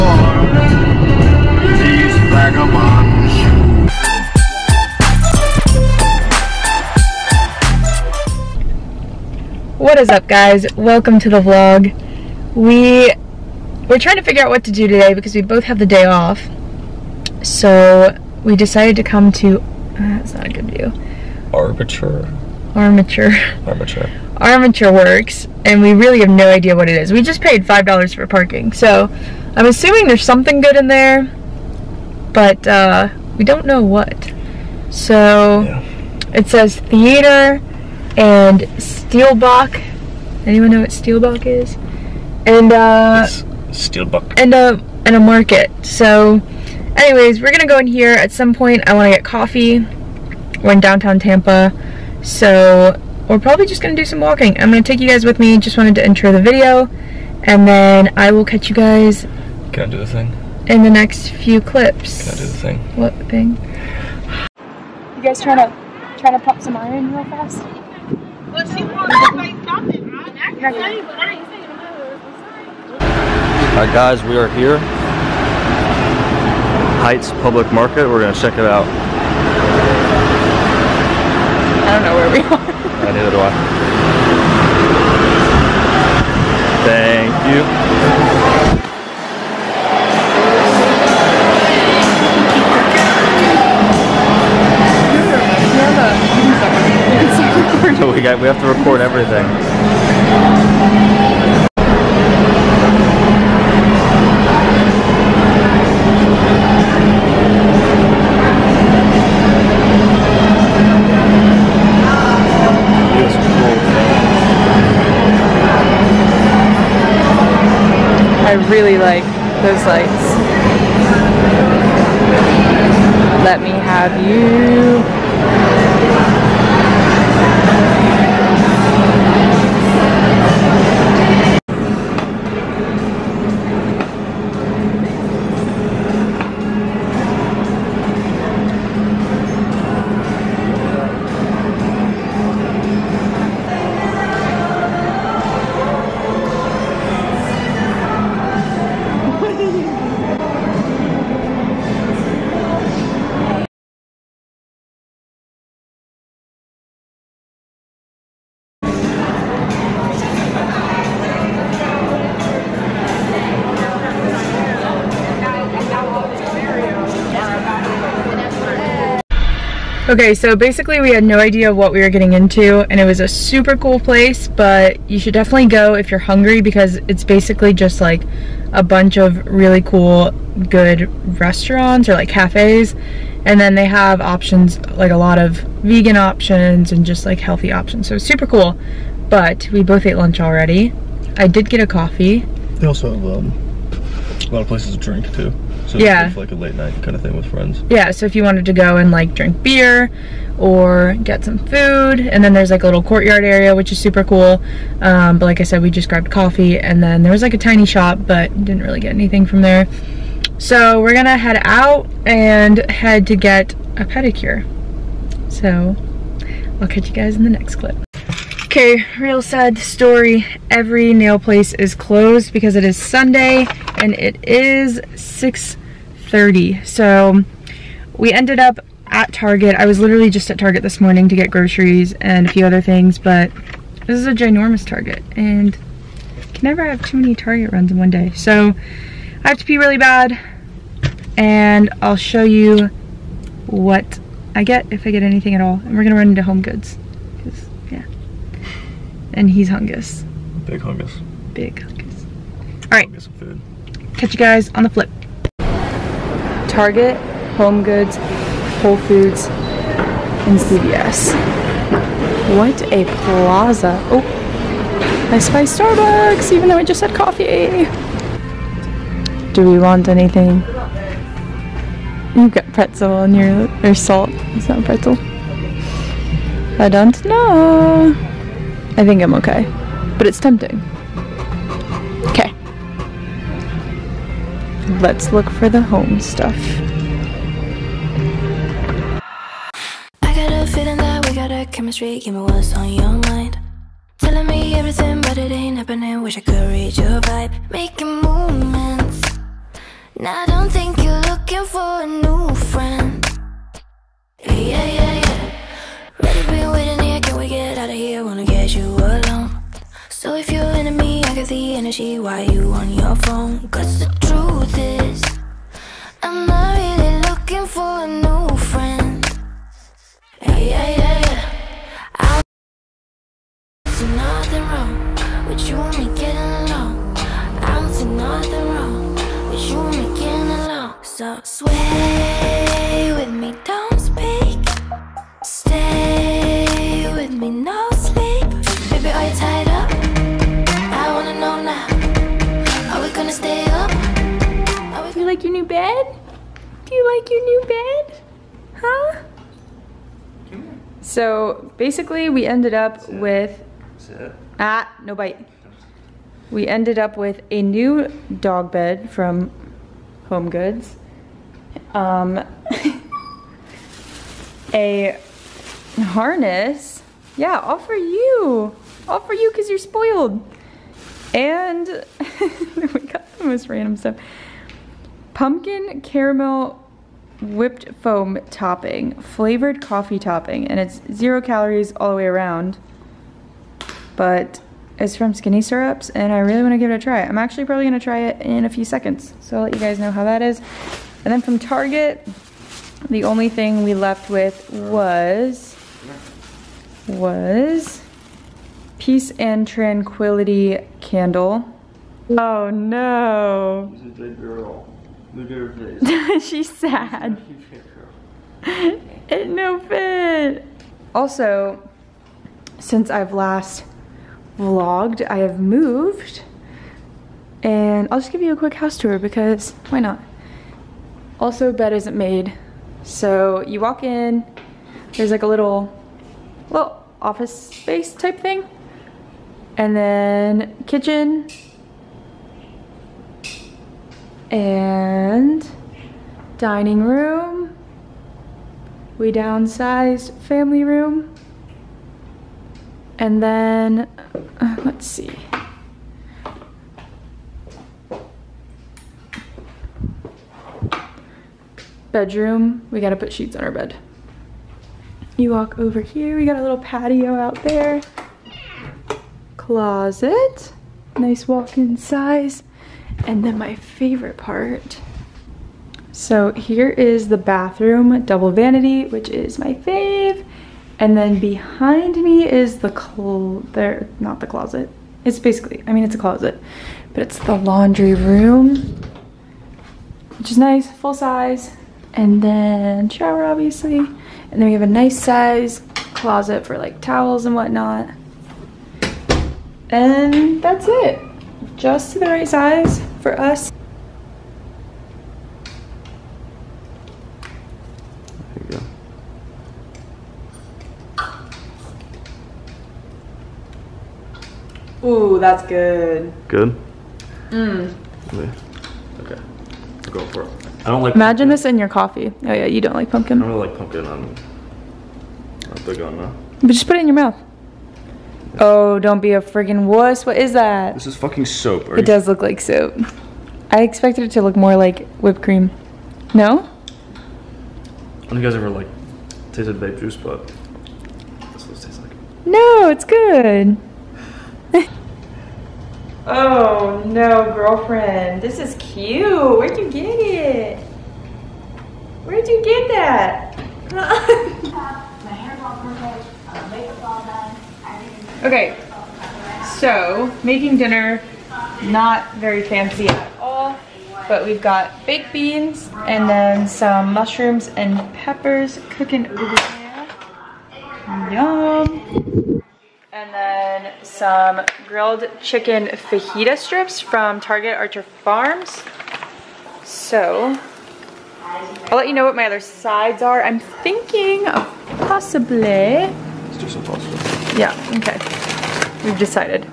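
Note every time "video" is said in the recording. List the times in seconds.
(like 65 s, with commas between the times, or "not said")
56 s.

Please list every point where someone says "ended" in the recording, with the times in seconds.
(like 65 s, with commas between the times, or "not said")
228 s, 352 s, 356 s.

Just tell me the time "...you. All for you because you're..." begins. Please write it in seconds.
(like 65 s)
367 s.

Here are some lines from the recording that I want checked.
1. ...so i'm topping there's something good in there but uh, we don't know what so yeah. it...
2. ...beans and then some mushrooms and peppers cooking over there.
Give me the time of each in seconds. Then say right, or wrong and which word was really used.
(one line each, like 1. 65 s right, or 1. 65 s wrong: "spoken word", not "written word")
1. 28 s wrong: "assuming", not "topping"
2. 555 s right.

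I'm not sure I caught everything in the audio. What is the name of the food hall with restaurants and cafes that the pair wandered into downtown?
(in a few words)
Heights Public Market.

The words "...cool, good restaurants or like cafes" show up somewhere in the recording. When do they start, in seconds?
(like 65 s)
179 s.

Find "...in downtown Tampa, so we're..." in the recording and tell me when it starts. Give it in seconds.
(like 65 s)
50 s.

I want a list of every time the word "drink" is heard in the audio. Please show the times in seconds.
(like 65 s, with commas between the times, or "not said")
195 s, 199 s.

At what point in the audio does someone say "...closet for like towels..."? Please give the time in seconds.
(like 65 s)
486 s.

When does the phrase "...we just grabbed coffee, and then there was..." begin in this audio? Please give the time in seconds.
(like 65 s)
205 s.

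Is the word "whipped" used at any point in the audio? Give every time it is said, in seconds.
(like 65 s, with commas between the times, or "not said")
377 s, 525 s.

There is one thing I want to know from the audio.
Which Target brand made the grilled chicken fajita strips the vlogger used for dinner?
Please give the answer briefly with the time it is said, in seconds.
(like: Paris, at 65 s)
Archer Farms, at 567 s.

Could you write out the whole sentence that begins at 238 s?
So I have to pee really bad and I'll show you what I get if I get anything at all.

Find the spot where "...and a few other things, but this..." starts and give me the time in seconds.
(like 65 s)
232 s.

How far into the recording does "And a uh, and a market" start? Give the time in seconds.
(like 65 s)
44 s.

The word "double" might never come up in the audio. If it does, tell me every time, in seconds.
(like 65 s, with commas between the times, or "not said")
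468 s.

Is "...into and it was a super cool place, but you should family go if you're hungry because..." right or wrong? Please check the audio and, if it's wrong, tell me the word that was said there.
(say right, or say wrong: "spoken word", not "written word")
wrong: "definitely", not "family".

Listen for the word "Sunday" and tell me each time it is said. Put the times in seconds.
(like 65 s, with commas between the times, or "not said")
222 s.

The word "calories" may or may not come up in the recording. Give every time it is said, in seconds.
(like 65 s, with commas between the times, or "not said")
381 s.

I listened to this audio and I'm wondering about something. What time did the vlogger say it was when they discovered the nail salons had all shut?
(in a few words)
6:30.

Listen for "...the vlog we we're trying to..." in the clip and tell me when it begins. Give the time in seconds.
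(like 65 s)
11 s.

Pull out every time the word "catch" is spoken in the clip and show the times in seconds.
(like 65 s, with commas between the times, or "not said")
58 s, 216 s, 254 s.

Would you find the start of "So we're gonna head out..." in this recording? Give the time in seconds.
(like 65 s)
210 s.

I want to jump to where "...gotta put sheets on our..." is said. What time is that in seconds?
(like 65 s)
453 s.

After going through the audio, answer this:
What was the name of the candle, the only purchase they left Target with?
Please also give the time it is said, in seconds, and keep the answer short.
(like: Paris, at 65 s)
Peace and Tranquility, at 398 s.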